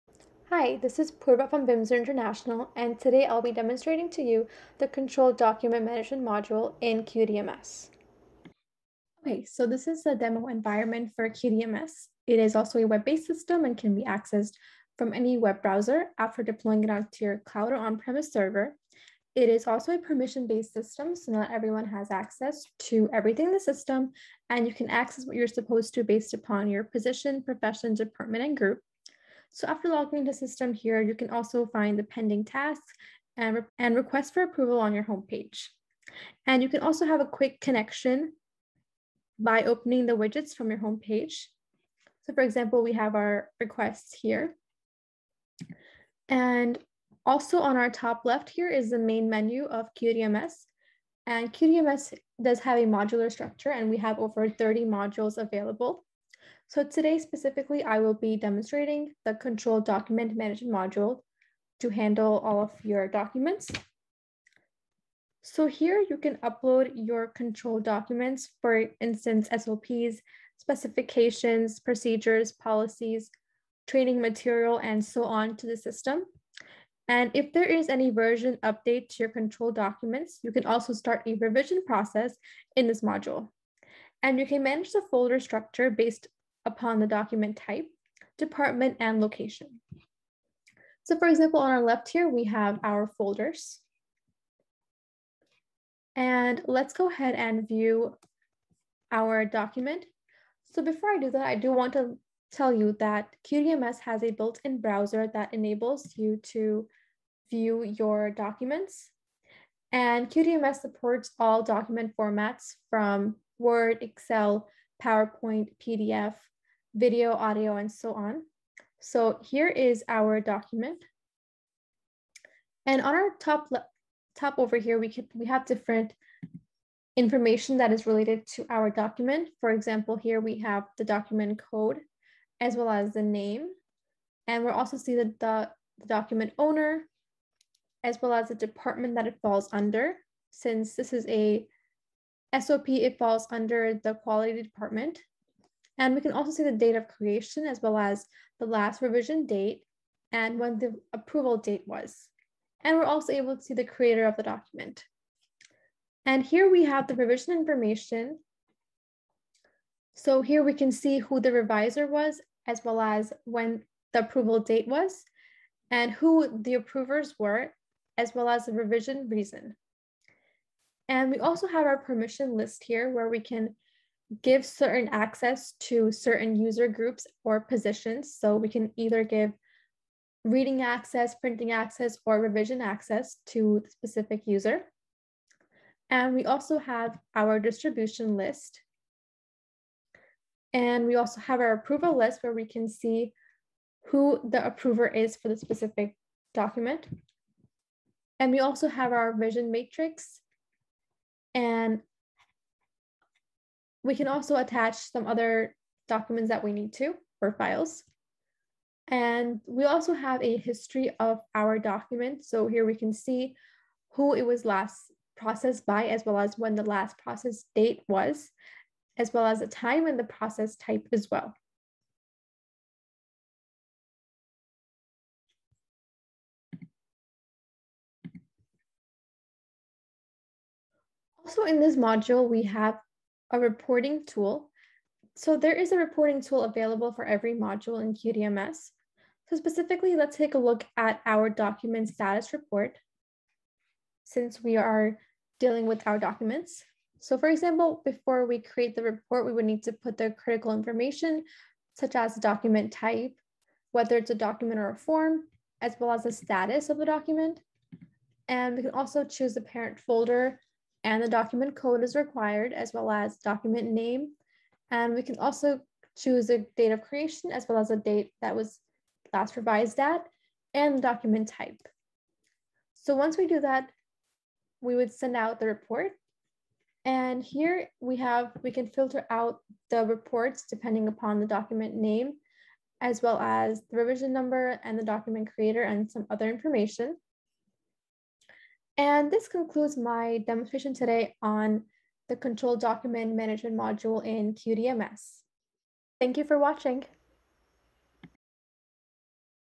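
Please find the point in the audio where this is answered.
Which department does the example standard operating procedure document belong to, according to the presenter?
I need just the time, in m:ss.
2:24.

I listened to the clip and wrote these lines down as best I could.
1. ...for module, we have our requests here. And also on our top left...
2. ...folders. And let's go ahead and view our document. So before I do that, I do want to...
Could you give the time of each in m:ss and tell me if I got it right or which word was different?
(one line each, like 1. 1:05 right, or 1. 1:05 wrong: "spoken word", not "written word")
1. 0:42 wrong: "example", not "module"
2. 1:33 right.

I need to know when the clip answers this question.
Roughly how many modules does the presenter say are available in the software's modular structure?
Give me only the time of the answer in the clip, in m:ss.
0:54.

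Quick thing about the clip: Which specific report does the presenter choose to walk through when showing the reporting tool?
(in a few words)
document status report.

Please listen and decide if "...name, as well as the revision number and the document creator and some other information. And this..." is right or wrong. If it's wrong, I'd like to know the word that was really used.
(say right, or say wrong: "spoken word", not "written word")
right.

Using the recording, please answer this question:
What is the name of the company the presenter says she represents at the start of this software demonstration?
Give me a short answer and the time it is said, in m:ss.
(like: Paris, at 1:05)
BIMSER International, at 0:01.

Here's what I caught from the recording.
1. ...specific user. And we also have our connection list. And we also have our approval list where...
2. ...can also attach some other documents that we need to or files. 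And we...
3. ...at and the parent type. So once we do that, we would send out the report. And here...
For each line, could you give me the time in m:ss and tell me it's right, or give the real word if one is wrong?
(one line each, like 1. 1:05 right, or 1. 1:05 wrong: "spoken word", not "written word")
1. 3:03 wrong: "distribution", not "connection"
2. 3:24 right
3. 4:29 wrong: "document", not "parent".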